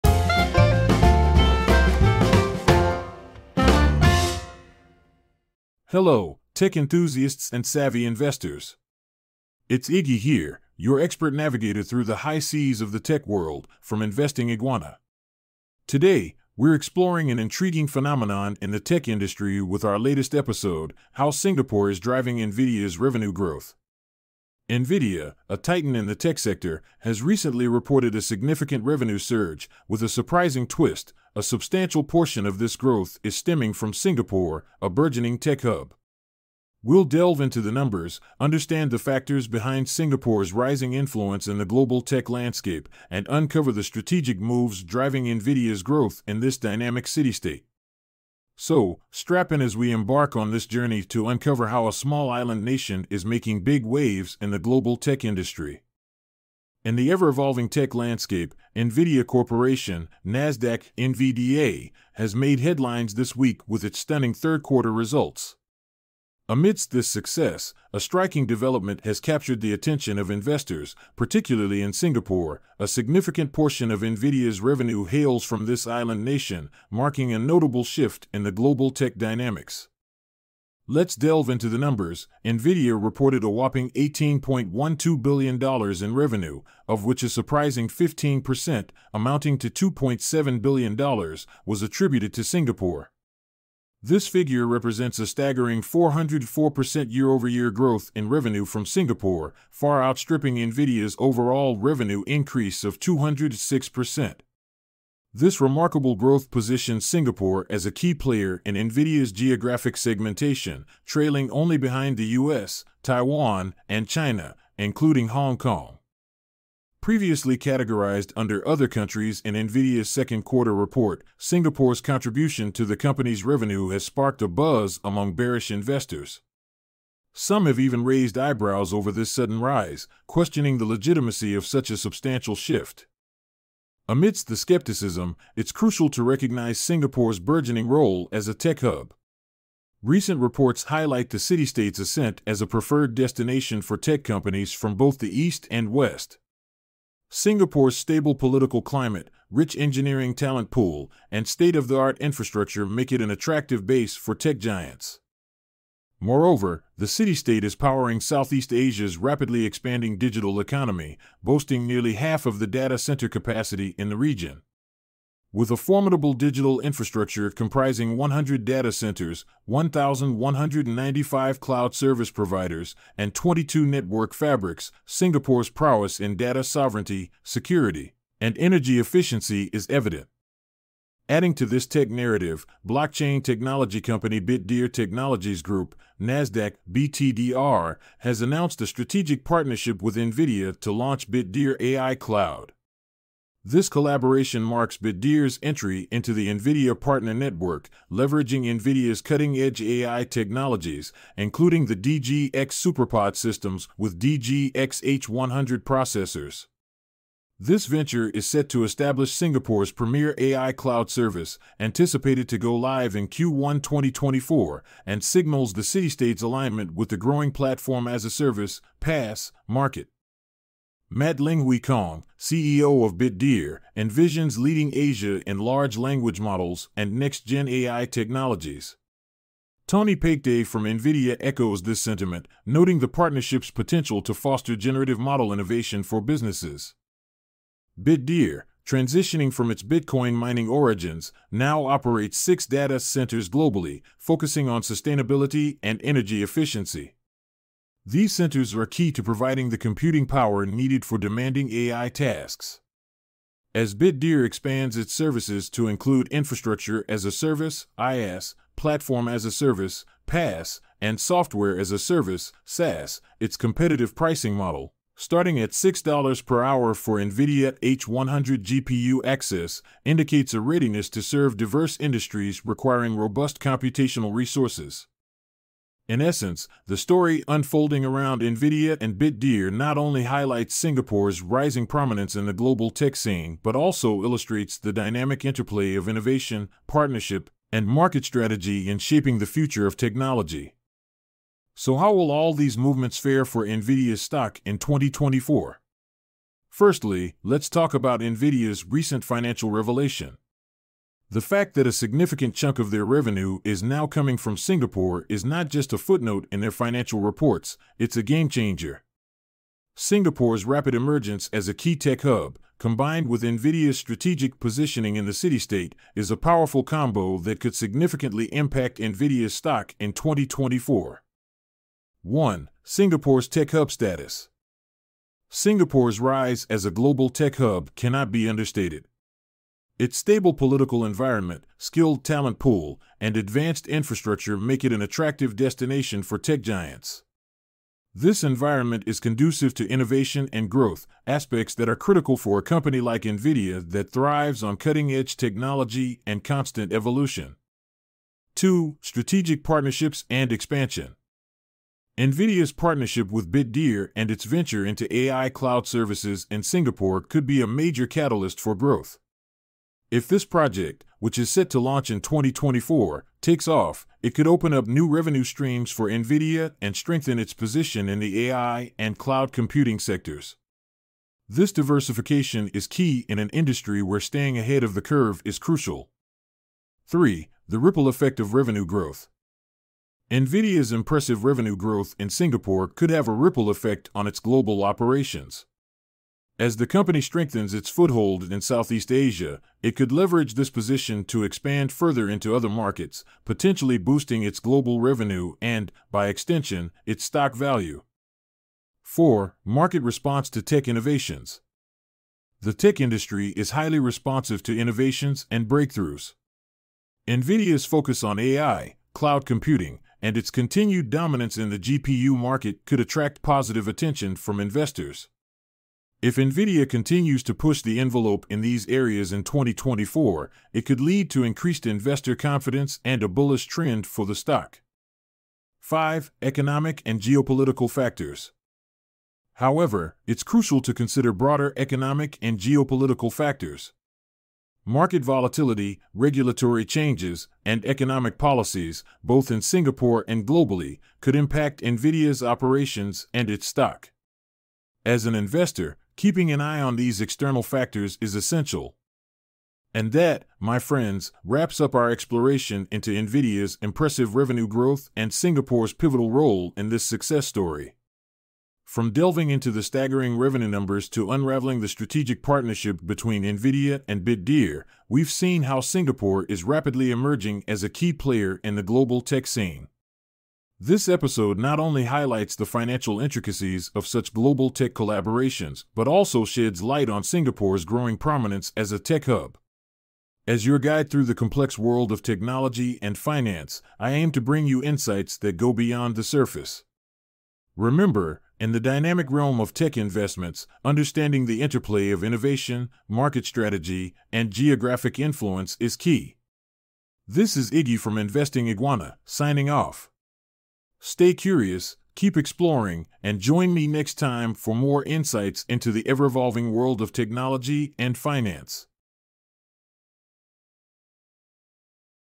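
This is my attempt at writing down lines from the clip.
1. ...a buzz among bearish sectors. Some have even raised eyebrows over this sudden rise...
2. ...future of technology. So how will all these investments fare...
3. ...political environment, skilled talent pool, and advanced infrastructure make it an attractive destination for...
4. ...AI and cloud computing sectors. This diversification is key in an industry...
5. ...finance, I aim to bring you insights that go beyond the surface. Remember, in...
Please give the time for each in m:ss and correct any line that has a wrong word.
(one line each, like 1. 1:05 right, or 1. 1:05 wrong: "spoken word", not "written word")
1. 2:04 wrong: "investors", not "sectors"
2. 4:49 wrong: "movements", not "investments"
3. 5:30 right
4. 6:08 right
5. 8:03 right.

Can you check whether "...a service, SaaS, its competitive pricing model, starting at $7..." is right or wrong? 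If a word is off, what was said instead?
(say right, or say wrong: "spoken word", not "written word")
wrong: "6", not "7".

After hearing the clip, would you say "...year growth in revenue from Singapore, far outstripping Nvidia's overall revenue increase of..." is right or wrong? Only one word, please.
right.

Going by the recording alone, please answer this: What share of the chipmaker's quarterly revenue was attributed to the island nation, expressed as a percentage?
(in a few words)
15%.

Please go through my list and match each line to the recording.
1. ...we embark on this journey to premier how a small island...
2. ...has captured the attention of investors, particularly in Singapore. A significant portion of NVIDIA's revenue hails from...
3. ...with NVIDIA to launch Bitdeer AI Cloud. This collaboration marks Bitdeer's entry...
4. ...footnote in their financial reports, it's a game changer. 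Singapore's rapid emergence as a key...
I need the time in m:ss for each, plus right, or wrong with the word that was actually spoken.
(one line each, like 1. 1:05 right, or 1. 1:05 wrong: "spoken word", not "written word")
1. 0:49 wrong: "uncover", not "premier"
2. 1:09 right
3. 3:10 right
4. 5:05 right.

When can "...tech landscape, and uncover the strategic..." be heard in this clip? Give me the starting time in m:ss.
0:42.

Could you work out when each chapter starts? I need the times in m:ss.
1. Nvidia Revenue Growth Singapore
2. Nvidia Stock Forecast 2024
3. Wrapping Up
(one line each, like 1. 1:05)
1. 0:57
2. 4:50
3. 7:29.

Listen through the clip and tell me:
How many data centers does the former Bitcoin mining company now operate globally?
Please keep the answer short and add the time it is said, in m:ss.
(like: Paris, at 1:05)
6, at 4:02.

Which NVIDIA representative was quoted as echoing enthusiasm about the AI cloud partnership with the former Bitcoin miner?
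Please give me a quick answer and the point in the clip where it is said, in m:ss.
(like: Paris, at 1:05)
Tony Paikeday, at 3:49.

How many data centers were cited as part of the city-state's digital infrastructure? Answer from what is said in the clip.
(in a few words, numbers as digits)
100.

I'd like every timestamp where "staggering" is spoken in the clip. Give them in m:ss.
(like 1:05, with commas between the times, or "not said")
1:35, 7:39.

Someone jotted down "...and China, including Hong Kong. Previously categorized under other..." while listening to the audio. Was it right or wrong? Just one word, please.
right.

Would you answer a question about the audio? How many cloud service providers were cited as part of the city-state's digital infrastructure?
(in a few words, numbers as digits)
1,195.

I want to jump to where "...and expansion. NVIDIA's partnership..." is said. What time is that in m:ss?
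5:50.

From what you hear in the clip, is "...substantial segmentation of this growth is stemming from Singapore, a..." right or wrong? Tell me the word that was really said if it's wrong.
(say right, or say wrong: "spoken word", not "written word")
wrong: "portion", not "segmentation".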